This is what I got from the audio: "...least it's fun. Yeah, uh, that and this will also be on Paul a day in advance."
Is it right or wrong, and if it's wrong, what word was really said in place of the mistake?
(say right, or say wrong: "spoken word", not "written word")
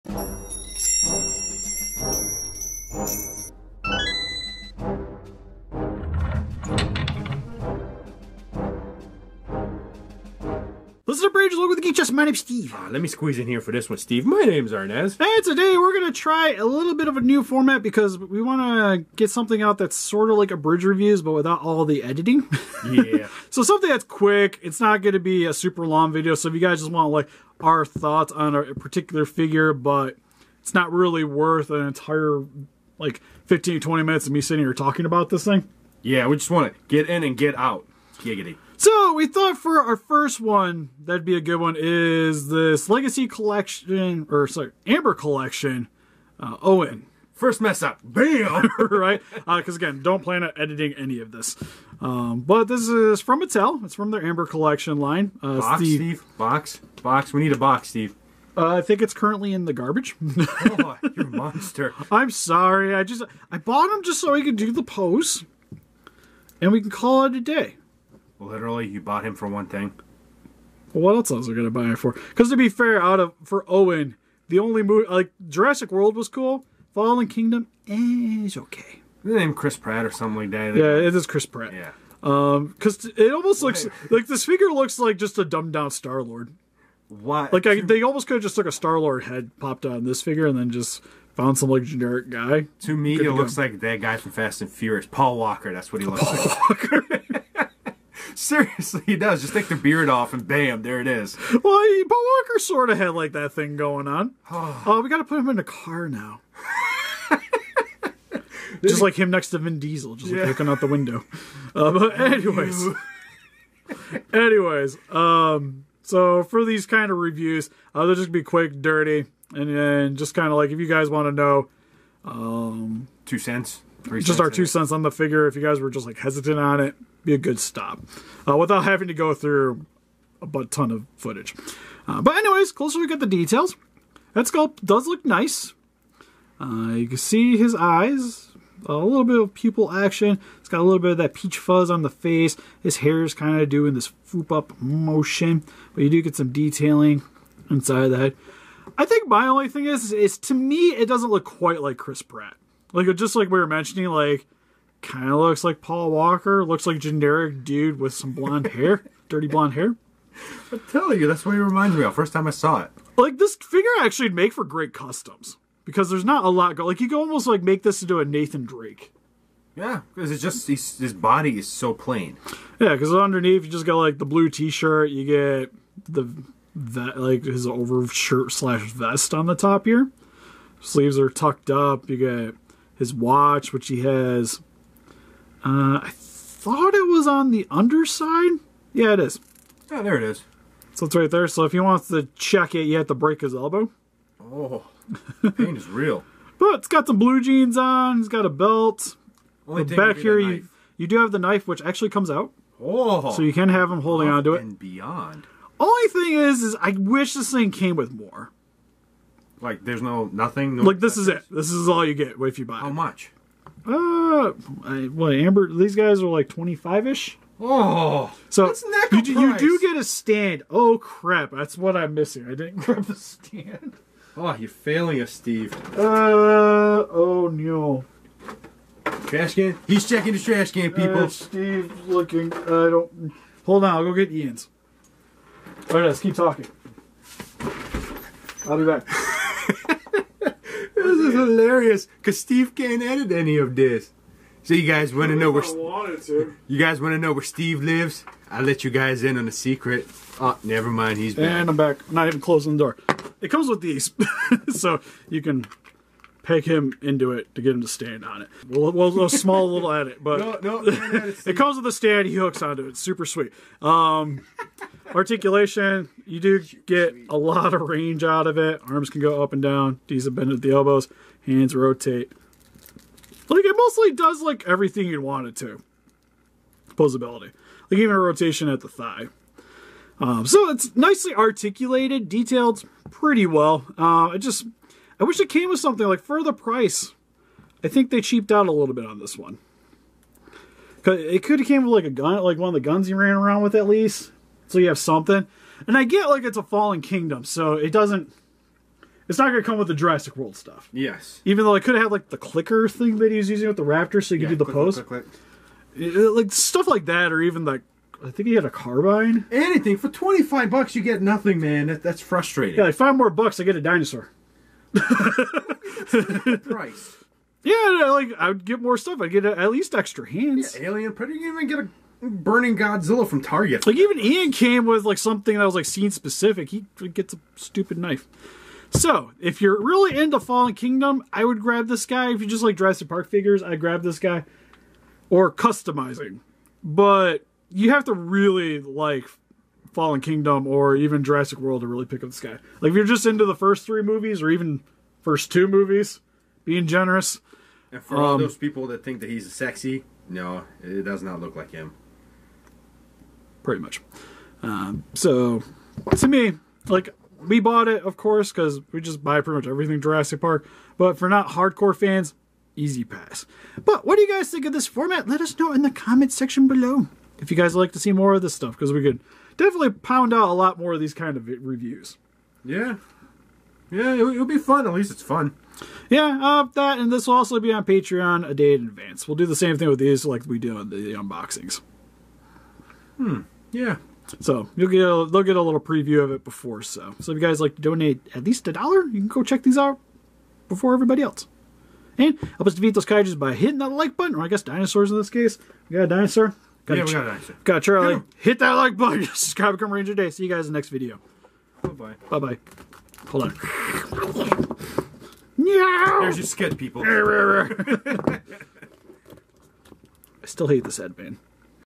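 wrong: "Patreon", not "Paul".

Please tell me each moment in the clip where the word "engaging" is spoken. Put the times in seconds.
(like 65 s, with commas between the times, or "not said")
not said.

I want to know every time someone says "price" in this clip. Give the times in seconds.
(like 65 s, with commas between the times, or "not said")
286 s, 314 s.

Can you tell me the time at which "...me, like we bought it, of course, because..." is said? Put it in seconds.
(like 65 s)
356 s.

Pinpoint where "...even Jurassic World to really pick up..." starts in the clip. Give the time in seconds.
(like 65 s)
340 s.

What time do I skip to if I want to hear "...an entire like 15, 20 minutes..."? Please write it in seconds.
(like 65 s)
31 s.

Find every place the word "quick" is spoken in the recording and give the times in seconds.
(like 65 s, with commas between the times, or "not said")
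24 s, 118 s.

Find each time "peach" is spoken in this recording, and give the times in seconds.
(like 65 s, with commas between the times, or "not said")
141 s.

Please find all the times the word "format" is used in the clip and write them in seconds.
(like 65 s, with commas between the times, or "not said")
17 s, 364 s.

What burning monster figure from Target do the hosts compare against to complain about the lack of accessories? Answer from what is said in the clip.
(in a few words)
Godzilla.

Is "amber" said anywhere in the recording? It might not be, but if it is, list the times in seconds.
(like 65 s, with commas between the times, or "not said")
44 s, 54 s, 215 s.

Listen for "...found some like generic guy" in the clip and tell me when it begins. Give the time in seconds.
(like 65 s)
91 s.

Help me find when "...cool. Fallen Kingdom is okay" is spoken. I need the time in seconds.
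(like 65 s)
76 s.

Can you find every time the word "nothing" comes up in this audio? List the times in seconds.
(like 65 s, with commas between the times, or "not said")
210 s, 311 s.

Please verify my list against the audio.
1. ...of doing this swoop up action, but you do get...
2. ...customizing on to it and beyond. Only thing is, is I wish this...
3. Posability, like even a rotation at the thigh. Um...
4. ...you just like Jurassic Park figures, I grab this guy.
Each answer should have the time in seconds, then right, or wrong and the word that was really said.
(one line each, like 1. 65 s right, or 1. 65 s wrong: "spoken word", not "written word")
1. 143 s wrong: "motion", not "action"
2. 204 s wrong: "holding", not "customizing"
3. 276 s right
4. 332 s right.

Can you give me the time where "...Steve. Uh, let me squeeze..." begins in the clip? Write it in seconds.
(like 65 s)
12 s.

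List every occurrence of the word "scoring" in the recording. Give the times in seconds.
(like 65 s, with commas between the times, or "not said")
not said.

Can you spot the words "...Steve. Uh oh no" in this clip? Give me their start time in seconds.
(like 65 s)
225 s.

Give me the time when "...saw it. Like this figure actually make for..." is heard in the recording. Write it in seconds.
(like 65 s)
162 s.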